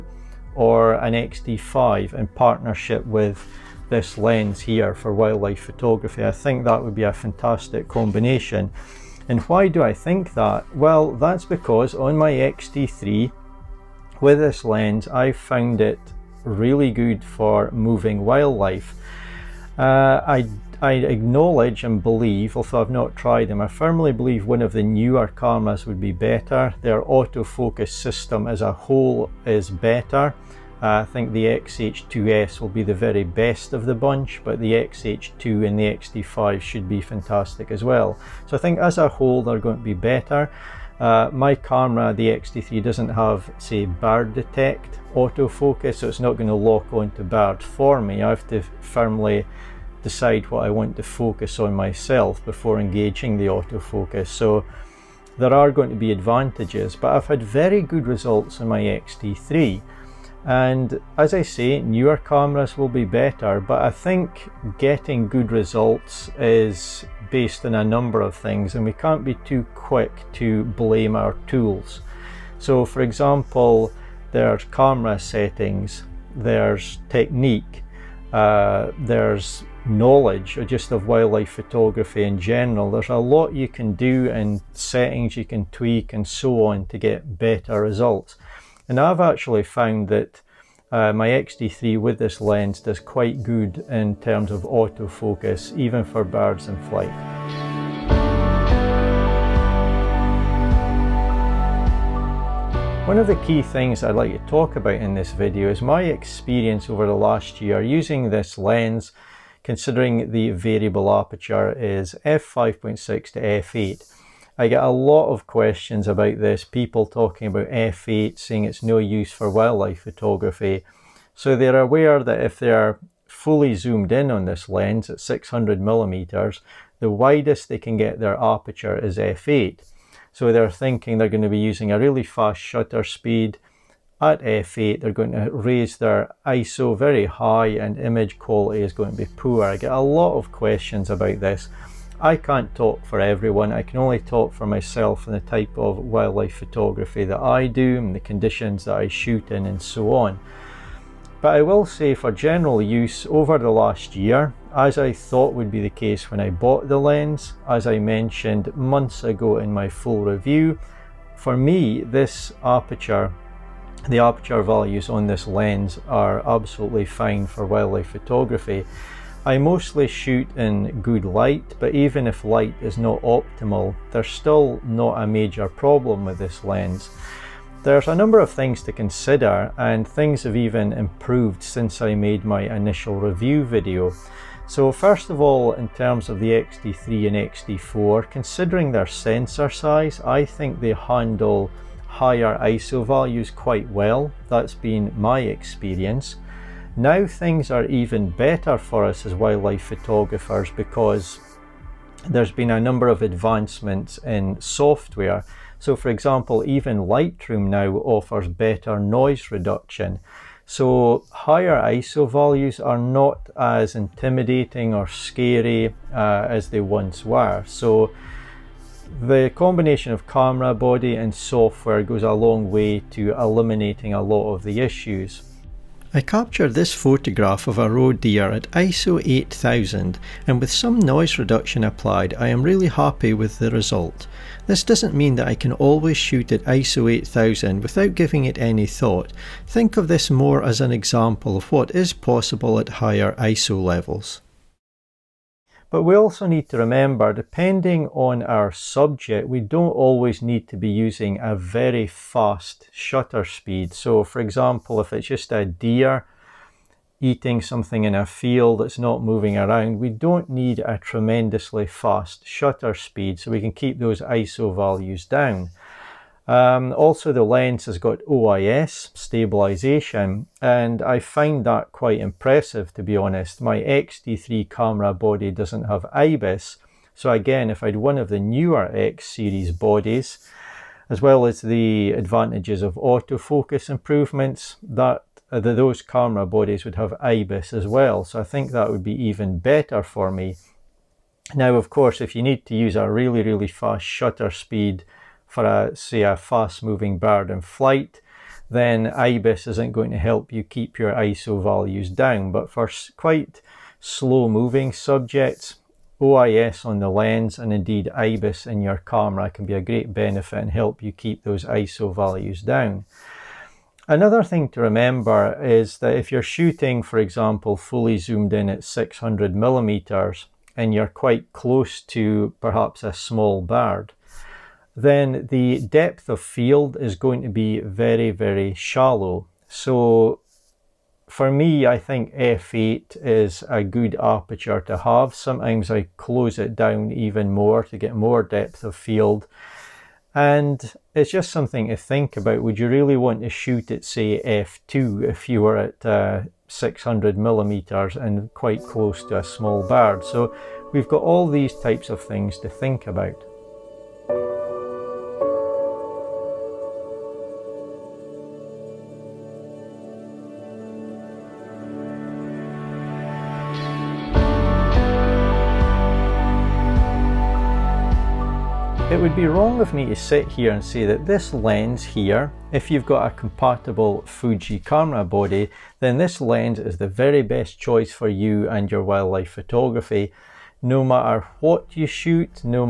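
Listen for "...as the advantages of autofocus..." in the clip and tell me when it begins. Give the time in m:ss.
4:41.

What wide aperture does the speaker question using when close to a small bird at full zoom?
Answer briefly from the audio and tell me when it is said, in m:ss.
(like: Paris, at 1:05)
f2, at 5:44.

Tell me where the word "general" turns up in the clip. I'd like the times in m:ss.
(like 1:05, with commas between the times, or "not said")
1:22, 2:32.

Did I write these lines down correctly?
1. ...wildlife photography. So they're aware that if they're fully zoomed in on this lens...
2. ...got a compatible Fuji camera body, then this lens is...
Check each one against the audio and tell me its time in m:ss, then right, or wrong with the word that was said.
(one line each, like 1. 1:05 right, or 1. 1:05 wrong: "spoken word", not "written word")
1. 1:59 right
2. 6:13 right.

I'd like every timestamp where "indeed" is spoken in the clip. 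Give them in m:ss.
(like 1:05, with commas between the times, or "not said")
5:07.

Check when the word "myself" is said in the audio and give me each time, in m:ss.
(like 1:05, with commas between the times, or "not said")
0:51, 2:24.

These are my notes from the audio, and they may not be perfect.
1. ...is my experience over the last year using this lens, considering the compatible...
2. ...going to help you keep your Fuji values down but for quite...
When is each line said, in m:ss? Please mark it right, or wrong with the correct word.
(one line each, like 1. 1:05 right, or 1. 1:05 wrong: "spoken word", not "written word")
1. 1:45 wrong: "variable", not "compatible"
2. 4:59 wrong: "ISO", not "Fuji".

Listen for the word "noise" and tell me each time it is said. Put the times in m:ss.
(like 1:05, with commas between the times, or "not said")
3:28, 3:50.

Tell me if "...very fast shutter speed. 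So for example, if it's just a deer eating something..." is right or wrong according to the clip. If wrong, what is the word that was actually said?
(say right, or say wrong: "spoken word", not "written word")
right.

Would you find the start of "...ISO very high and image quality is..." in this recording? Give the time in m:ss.
2:16.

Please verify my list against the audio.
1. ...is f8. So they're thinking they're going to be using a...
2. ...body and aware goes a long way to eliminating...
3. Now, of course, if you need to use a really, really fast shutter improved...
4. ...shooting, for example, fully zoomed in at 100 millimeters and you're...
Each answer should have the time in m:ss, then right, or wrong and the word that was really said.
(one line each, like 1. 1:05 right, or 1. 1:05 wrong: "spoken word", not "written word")
1. 2:08 right
2. 3:40 wrong: "software", not "aware"
3. 4:51 wrong: "speed", not "improved"
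4. 5:16 wrong: "600", not "100".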